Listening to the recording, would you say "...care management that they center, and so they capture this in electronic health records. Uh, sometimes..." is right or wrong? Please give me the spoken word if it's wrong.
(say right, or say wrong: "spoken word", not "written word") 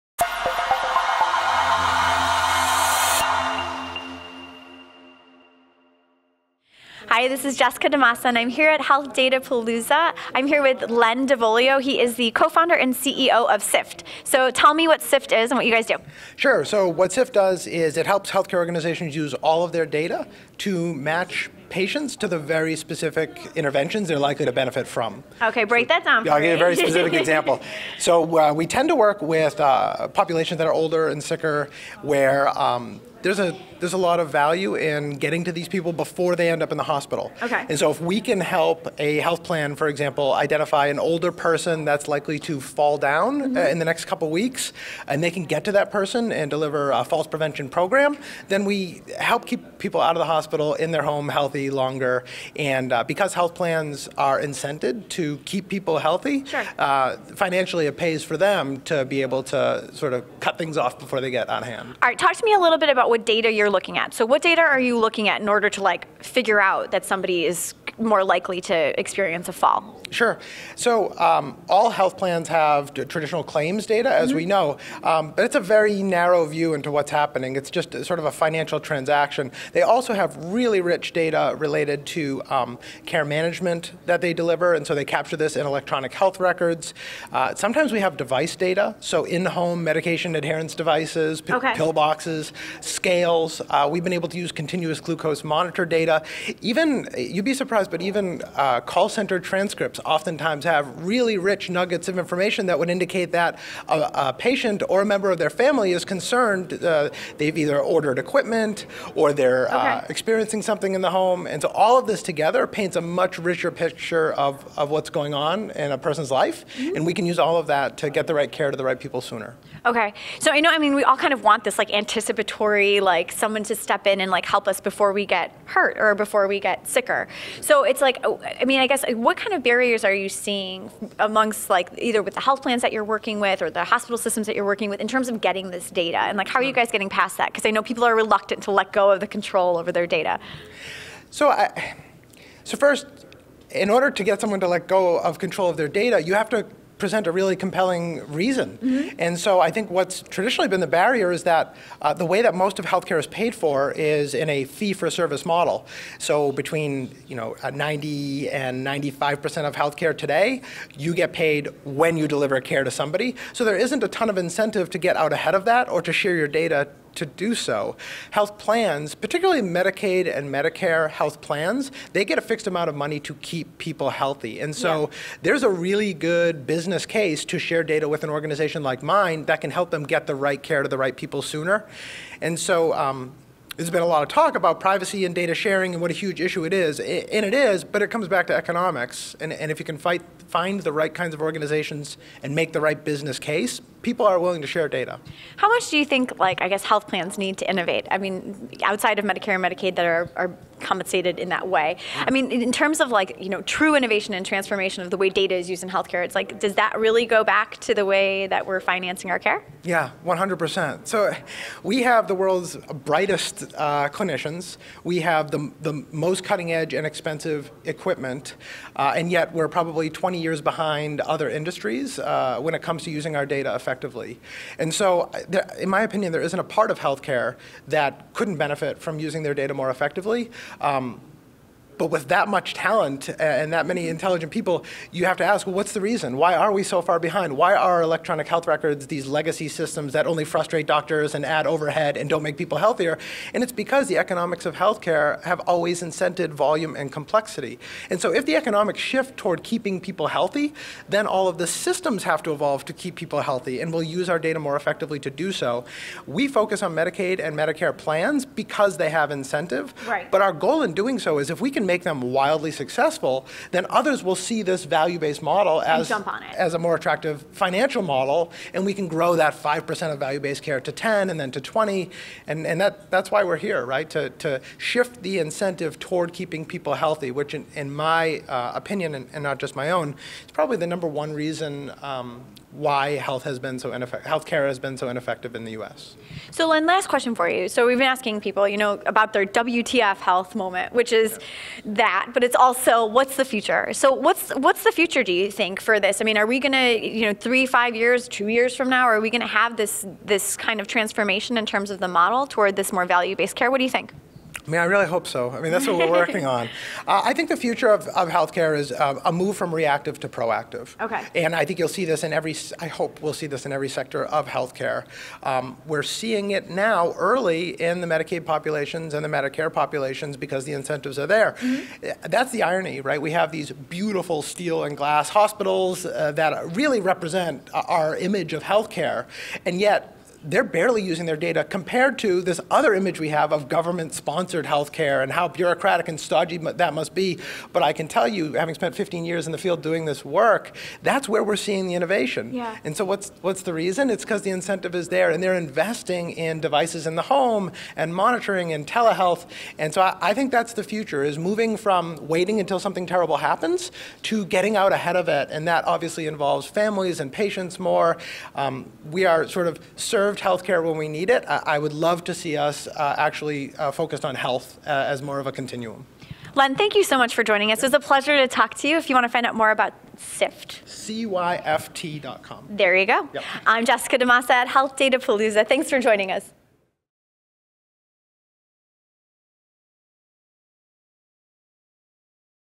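wrong: "deliver", not "center".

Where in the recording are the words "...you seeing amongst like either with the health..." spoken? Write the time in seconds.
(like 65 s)
130 s.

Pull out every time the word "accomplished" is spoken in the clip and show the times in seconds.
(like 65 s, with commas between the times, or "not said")
not said.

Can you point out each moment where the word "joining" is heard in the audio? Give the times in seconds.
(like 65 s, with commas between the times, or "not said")
367 s, 375 s.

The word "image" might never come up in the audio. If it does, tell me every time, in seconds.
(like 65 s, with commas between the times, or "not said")
328 s, 332 s.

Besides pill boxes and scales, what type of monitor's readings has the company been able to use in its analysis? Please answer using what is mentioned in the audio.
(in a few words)
continuous glucose monitor.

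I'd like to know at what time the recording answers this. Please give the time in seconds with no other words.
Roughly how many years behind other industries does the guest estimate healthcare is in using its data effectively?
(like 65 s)
220 s.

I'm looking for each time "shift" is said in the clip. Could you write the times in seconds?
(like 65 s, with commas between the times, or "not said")
248 s, 274 s.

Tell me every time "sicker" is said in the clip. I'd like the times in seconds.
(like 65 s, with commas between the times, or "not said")
31 s, 126 s.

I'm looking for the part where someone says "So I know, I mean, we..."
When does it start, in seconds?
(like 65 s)
120 s.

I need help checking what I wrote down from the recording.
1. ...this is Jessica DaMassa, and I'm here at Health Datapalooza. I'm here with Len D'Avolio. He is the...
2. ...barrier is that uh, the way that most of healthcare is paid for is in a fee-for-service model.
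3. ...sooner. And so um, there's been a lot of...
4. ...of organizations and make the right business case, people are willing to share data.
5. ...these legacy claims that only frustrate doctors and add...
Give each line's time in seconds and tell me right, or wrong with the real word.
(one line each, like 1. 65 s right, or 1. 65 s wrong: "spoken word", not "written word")
1. 7 s right
2. 151 s right
3. 181 s right
4. 191 s right
5. 239 s wrong: "systems", not "claims".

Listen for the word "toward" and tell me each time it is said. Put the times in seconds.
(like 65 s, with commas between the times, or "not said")
249 s, 275 s, 302 s.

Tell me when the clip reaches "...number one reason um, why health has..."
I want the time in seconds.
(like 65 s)
280 s.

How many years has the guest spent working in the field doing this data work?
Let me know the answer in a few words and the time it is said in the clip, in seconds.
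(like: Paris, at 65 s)
15, at 338 s.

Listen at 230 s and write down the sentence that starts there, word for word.
Um, but with that much talent and that many intelligent people, you have to ask, well, what's the reason?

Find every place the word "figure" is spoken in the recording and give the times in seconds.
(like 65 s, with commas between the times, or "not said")
66 s.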